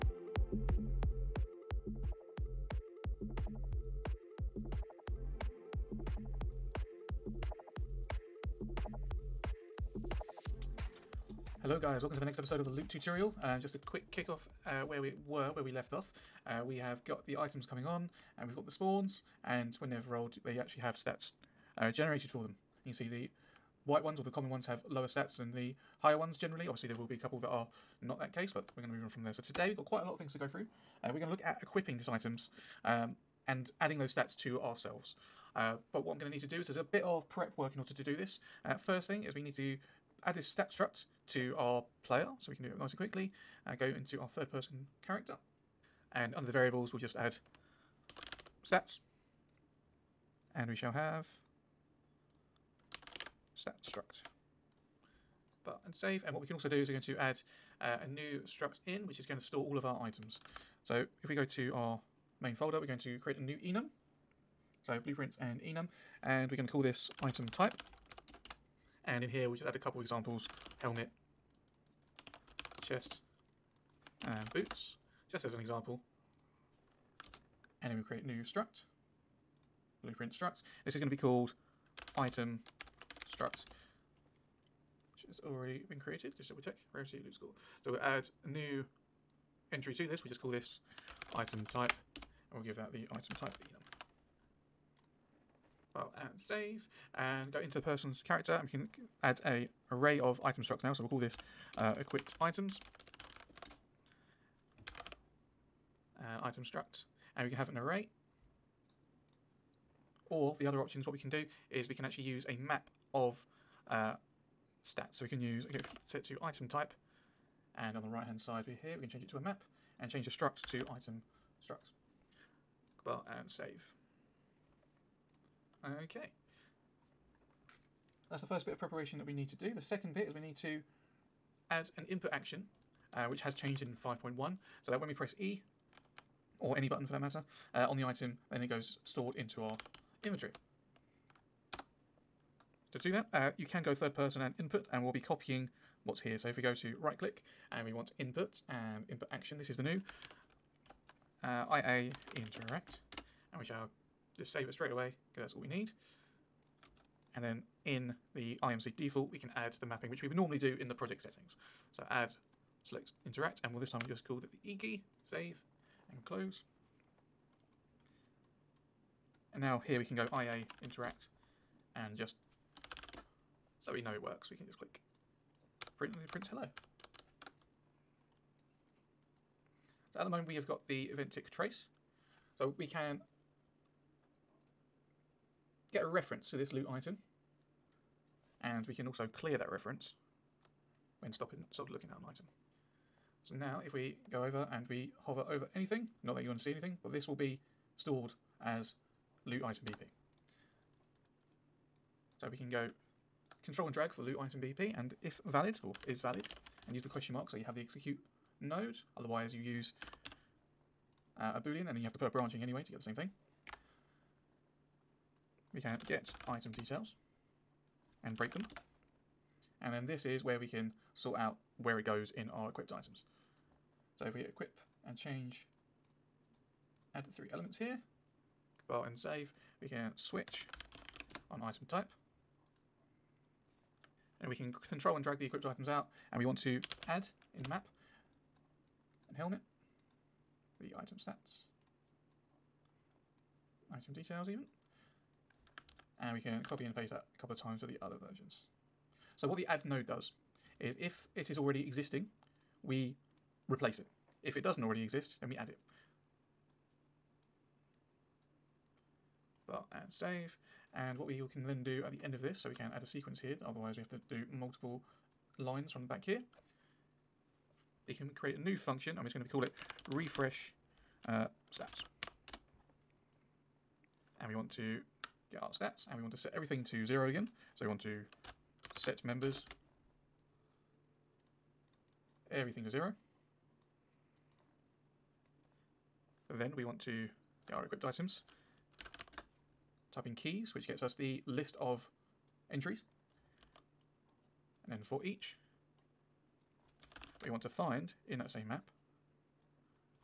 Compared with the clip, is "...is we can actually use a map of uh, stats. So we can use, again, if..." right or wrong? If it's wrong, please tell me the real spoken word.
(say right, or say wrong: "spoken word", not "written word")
right.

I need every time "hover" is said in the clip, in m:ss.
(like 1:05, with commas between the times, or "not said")
3:15.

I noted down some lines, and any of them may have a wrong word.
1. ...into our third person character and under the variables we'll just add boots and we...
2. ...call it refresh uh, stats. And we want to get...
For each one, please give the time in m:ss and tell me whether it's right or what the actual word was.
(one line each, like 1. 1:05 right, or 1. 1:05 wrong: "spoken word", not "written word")
1. 0:43 wrong: "stats", not "boots"
2. 4:29 right.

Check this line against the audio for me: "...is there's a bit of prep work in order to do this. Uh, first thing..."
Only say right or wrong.
right.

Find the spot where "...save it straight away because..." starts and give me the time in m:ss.
2:34.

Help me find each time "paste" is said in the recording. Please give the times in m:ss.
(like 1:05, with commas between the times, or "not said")
4:06.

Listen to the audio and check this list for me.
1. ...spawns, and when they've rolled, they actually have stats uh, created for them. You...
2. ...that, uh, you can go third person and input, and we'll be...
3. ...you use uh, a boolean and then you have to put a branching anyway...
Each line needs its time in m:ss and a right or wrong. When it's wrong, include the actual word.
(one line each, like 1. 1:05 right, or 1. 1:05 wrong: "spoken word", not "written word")
1. 0:18 wrong: "generated", not "created"
2. 2:23 right
3. 3:29 right.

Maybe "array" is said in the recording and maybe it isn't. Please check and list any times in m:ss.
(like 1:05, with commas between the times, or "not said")
1:39, 1:47.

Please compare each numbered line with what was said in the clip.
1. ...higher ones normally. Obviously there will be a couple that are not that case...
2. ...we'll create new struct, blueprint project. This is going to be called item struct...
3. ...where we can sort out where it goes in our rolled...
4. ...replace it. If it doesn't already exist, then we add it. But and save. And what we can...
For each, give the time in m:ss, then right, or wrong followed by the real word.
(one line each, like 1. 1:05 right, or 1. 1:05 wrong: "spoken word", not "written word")
1. 0:26 wrong: "generally", not "normally"
2. 1:17 wrong: "struct", not "project"
3. 3:40 wrong: "equipped", not "rolled"
4. 4:13 right.